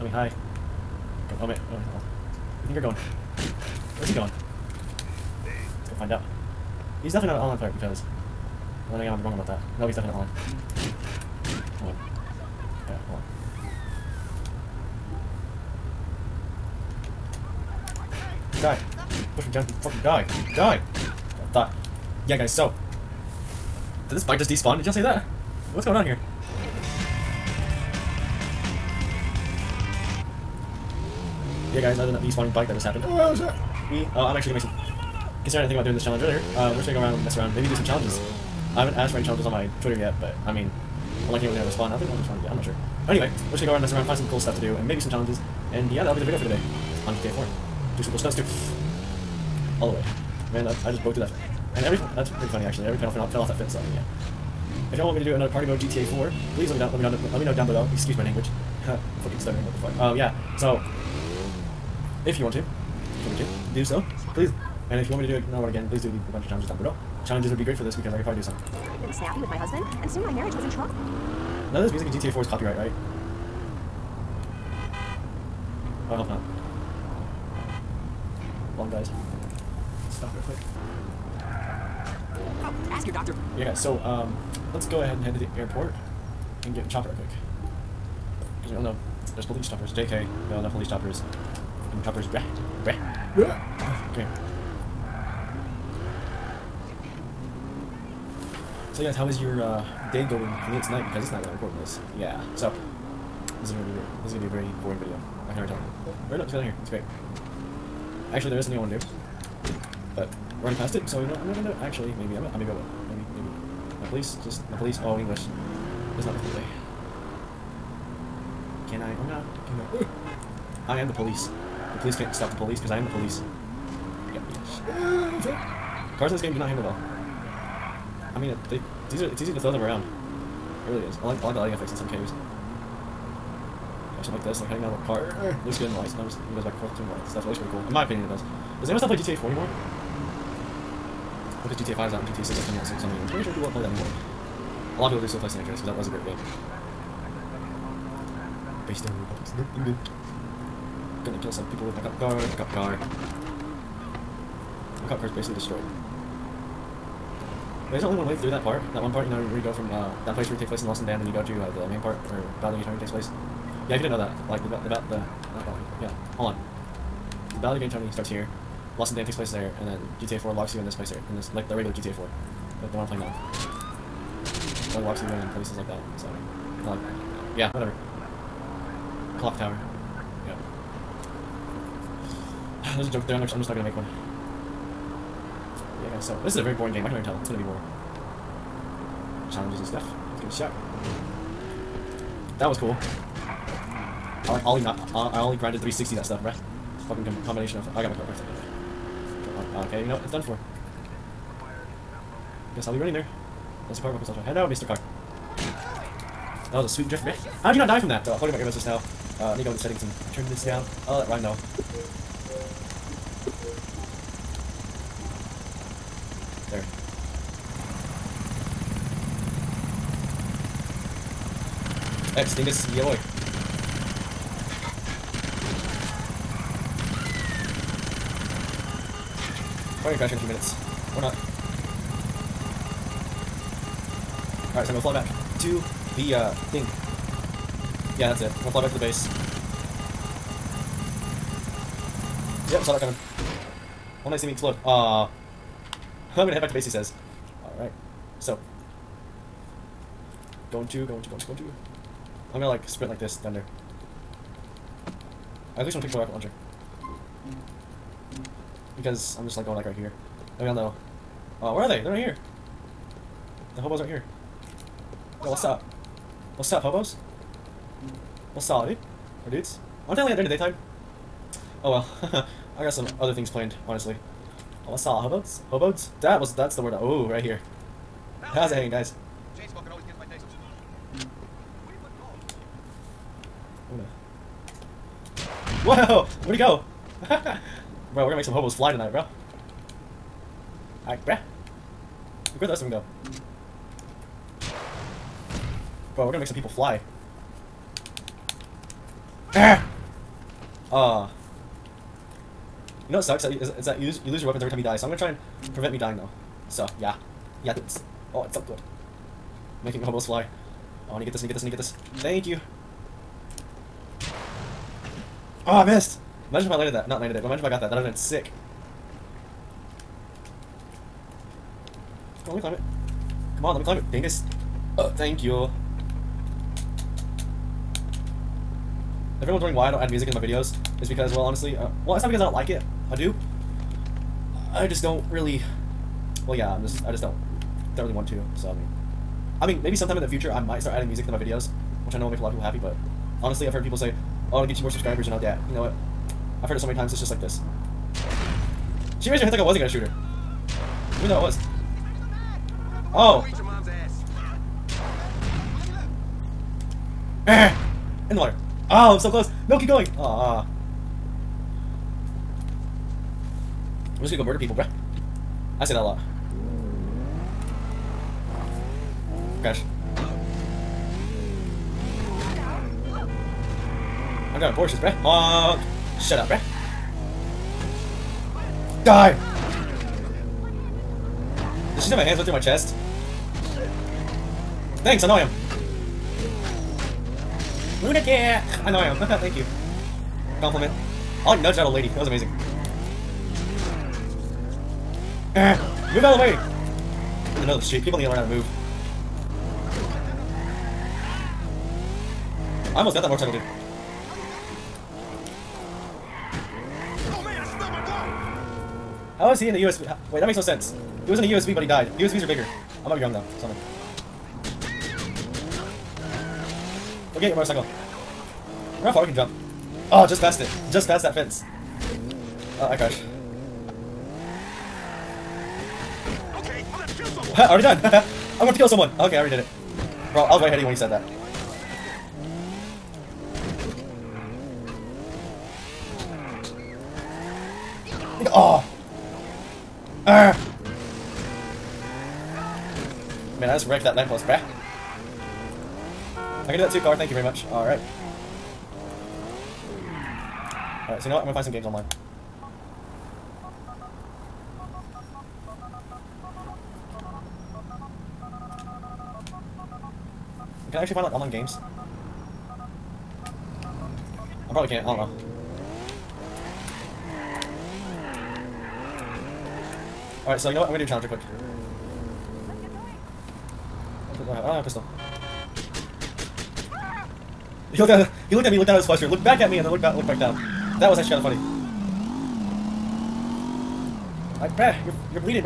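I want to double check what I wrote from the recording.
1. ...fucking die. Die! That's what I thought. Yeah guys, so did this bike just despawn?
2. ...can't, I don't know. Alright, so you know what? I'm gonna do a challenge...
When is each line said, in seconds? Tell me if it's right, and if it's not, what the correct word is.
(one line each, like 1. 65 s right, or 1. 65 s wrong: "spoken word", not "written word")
1. 19 s right
2. 464 s right.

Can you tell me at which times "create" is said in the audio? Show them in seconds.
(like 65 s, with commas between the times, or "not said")
not said.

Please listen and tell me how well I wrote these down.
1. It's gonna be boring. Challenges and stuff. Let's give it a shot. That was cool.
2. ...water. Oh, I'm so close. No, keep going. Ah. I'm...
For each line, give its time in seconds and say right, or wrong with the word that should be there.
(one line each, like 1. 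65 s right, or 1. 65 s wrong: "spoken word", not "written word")
1. 187 s right
2. 358 s right.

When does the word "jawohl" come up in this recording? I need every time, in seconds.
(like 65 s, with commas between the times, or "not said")
222 s.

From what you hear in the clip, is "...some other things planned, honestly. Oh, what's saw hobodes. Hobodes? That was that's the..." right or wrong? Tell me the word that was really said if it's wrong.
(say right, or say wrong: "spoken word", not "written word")
right.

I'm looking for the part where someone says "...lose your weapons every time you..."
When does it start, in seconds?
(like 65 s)
304 s.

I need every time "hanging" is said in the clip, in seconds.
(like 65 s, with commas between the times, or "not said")
134 s, 278 s.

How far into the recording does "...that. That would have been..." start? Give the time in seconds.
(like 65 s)
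317 s.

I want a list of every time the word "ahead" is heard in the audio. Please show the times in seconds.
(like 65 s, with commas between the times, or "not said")
85 s, 430 s.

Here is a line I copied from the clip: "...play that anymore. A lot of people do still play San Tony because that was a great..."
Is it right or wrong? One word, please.
wrong.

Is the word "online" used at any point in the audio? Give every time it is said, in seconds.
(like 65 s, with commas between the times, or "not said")
7 s, 451 s, 461 s.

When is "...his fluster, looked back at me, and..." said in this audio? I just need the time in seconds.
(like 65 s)
478 s.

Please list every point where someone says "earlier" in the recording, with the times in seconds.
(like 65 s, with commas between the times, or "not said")
36 s.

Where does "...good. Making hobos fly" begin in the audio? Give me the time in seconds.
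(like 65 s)
308 s.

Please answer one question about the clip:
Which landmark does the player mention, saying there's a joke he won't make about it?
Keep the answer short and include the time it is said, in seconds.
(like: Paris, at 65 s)
Clock tower, at 179 s.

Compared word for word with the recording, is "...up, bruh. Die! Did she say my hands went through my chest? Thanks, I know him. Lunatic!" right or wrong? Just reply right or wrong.
right.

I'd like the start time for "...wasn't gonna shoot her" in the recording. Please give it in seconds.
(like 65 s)
349 s.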